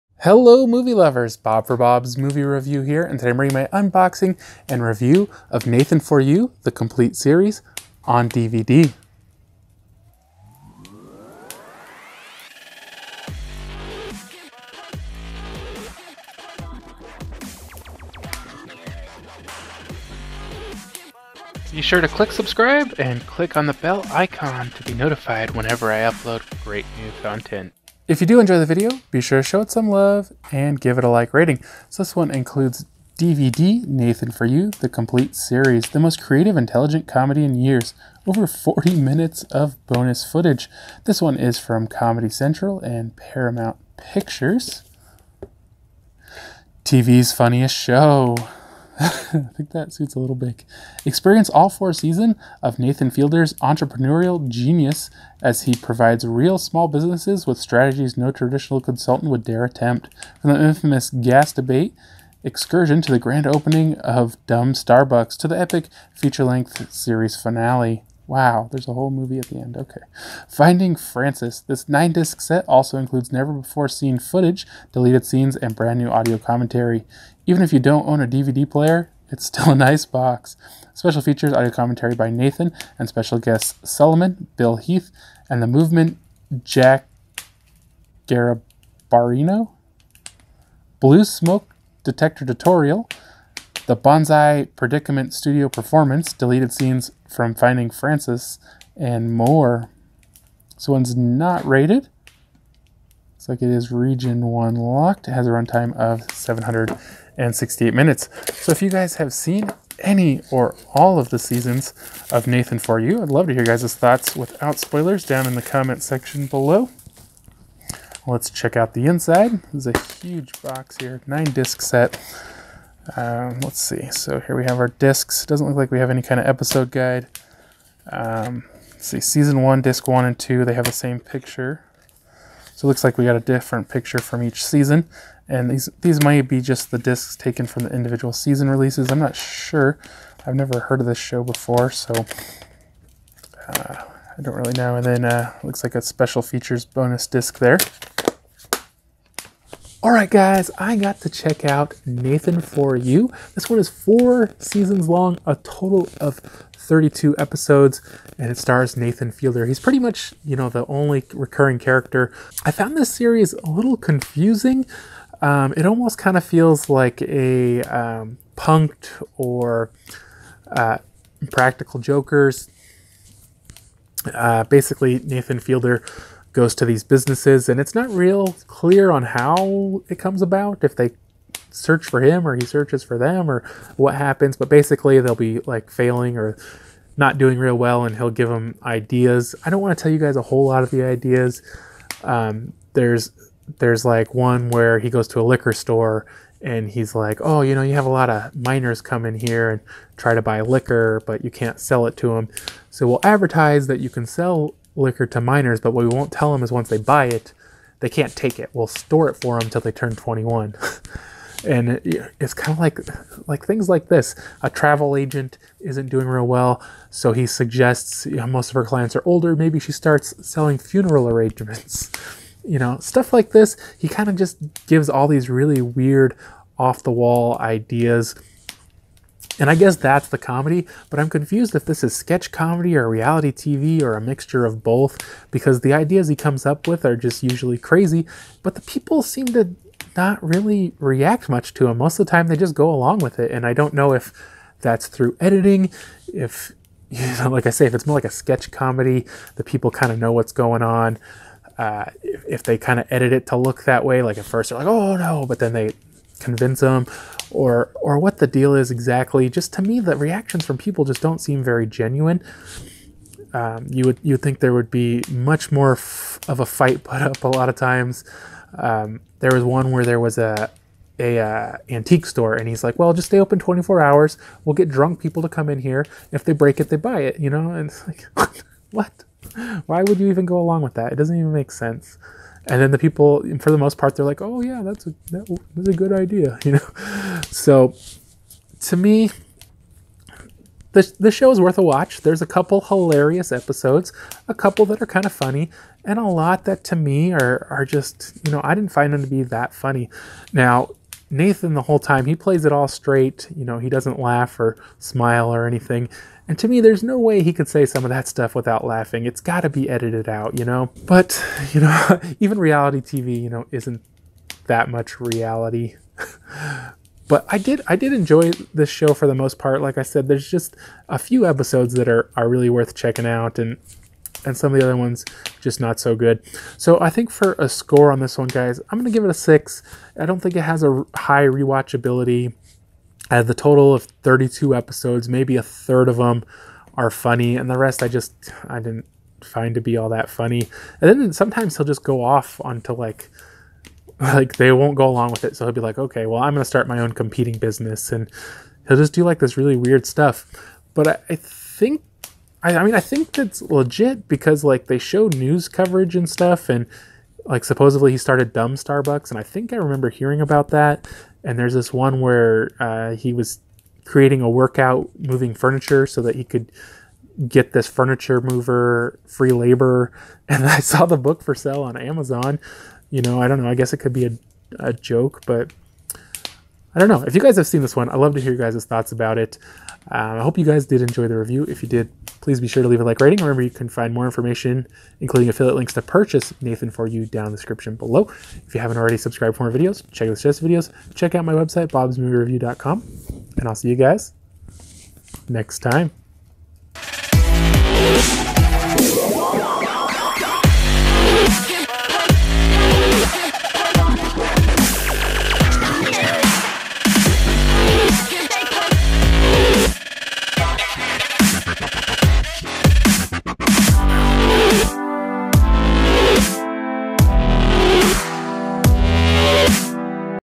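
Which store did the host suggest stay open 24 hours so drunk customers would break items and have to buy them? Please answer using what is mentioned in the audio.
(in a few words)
antique store.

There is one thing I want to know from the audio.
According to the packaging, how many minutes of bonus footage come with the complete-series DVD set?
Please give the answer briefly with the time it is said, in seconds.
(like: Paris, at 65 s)
over 40, at 38 s.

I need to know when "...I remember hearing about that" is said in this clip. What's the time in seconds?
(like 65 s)
359 s.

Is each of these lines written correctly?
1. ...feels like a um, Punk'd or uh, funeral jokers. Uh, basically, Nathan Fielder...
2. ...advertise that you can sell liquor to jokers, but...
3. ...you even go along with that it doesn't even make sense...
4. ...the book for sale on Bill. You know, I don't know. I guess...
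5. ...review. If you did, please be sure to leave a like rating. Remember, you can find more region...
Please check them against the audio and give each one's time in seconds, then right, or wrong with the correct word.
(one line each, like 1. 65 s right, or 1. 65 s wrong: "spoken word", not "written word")
1. 166 s wrong: "practical", not "funeral"
2. 203 s wrong: "minors", not "jokers"
3. 280 s right
4. 371 s wrong: "Amazon", not "Bill"
5. 381 s wrong: "information", not "region".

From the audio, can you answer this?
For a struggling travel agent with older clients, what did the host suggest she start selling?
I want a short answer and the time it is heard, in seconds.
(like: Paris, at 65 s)
funeral arrangements, at 220 s.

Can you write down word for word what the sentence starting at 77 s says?
Even if you don't own a DVD player, it's still a nice box.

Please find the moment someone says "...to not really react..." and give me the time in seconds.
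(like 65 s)
239 s.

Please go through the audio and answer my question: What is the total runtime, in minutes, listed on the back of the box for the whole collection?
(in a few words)
768.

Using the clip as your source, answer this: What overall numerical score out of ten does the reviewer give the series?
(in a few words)
6.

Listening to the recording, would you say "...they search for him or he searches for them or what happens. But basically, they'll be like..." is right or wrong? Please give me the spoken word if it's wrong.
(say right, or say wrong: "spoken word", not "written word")
right.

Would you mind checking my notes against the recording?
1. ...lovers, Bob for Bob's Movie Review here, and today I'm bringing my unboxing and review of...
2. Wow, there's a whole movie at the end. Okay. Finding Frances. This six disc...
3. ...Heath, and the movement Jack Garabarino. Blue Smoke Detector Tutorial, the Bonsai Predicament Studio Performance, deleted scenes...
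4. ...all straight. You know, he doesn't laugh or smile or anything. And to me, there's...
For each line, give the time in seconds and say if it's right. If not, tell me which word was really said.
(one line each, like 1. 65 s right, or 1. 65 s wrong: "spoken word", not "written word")
1. 0 s right
2. 68 s wrong: "nine", not "six"
3. 84 s right
4. 302 s right.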